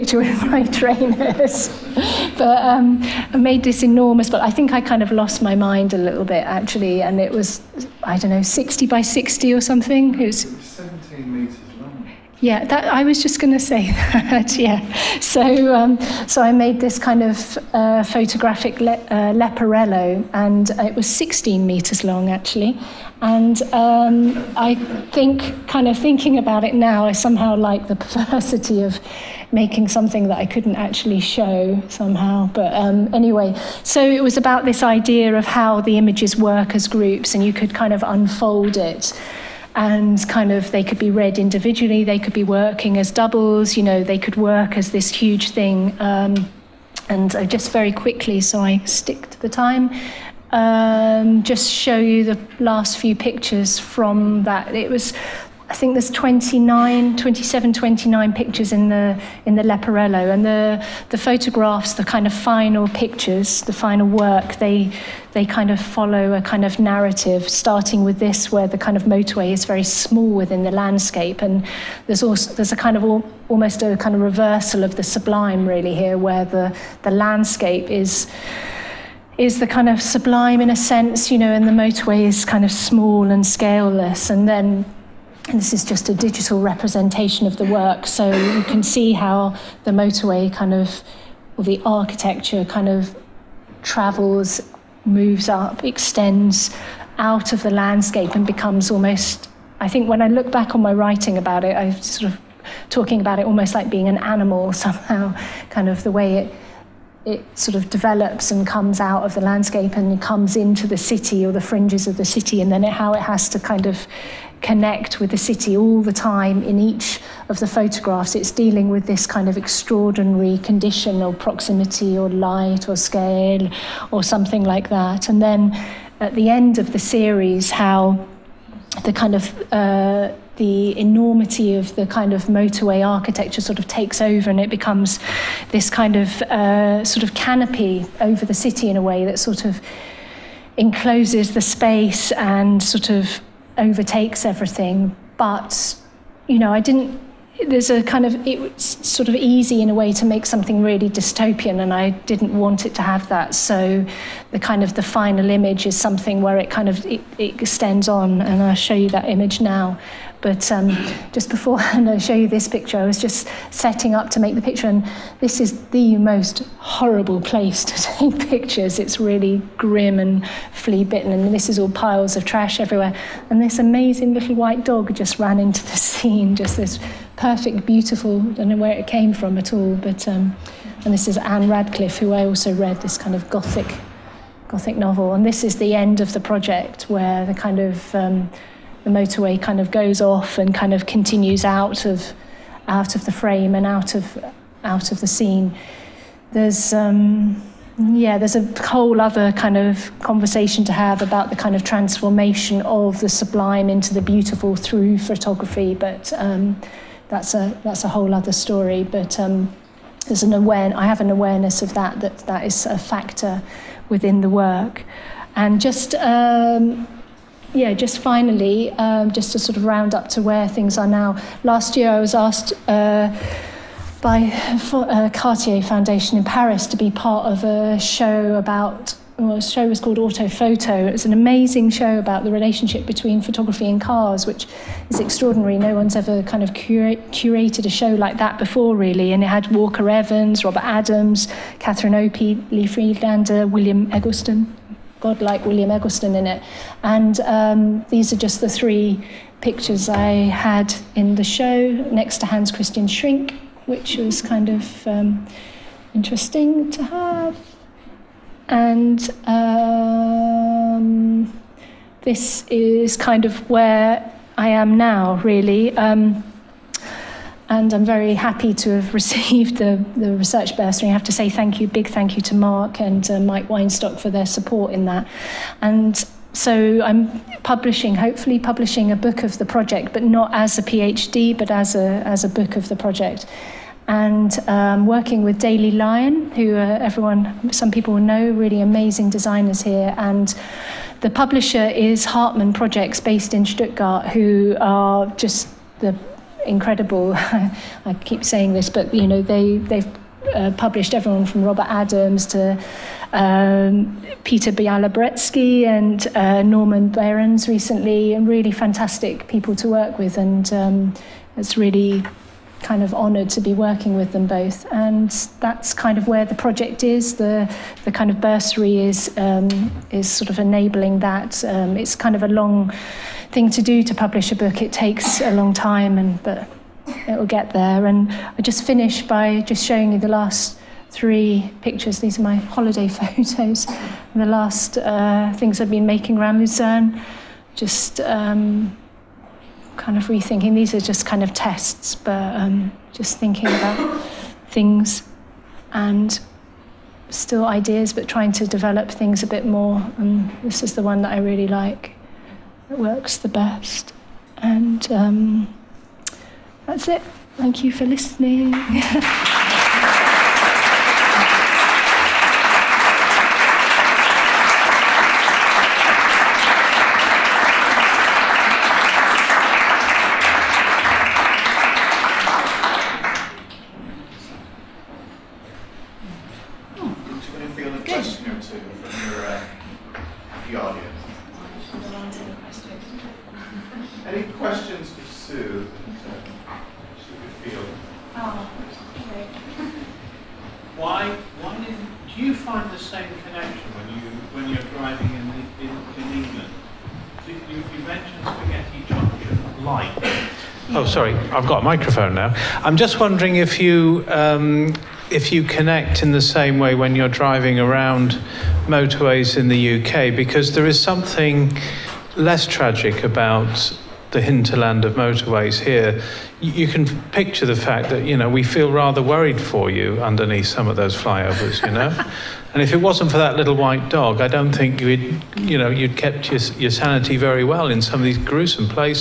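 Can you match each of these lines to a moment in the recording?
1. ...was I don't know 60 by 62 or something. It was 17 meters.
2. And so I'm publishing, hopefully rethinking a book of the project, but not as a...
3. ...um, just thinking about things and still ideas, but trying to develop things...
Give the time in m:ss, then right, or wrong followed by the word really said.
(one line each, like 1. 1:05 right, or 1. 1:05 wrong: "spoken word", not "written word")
1. 0:07 wrong: "60", not "62"
2. 4:35 wrong: "publishing", not "rethinking"
3. 5:42 right.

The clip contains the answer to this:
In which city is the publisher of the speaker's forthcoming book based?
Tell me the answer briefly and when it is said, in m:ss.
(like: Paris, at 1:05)
Stuttgart, at 4:53.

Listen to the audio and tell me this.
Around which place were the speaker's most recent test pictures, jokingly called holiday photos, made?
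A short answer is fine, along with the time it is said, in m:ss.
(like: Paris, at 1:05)
Lucerne, at 5:36.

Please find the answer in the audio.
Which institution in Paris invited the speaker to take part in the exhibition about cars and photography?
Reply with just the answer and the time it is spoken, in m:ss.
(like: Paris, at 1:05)
Cartier Foundation, at 3:45.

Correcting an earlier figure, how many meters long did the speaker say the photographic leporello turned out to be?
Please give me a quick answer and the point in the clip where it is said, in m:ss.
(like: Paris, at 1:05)
16 meters, at 0:21.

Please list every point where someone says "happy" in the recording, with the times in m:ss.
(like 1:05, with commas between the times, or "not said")
4:28.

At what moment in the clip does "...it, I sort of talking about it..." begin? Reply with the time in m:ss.
1:41.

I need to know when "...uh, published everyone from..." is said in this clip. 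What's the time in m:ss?
5:00.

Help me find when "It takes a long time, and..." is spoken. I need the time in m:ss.
5:24.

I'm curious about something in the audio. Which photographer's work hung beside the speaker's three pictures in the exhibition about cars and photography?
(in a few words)
Hans Christian Schink.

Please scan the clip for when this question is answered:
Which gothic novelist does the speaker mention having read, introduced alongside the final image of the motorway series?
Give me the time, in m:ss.
3:01.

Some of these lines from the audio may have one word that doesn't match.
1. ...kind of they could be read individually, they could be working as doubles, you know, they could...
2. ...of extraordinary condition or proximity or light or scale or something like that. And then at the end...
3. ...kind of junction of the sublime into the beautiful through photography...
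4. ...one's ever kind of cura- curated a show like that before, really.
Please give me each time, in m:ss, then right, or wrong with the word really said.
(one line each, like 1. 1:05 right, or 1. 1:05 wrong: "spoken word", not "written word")
1. 0:40 right
2. 1:59 right
3. 3:21 wrong: "transformation", not "junction"
4. 3:55 right.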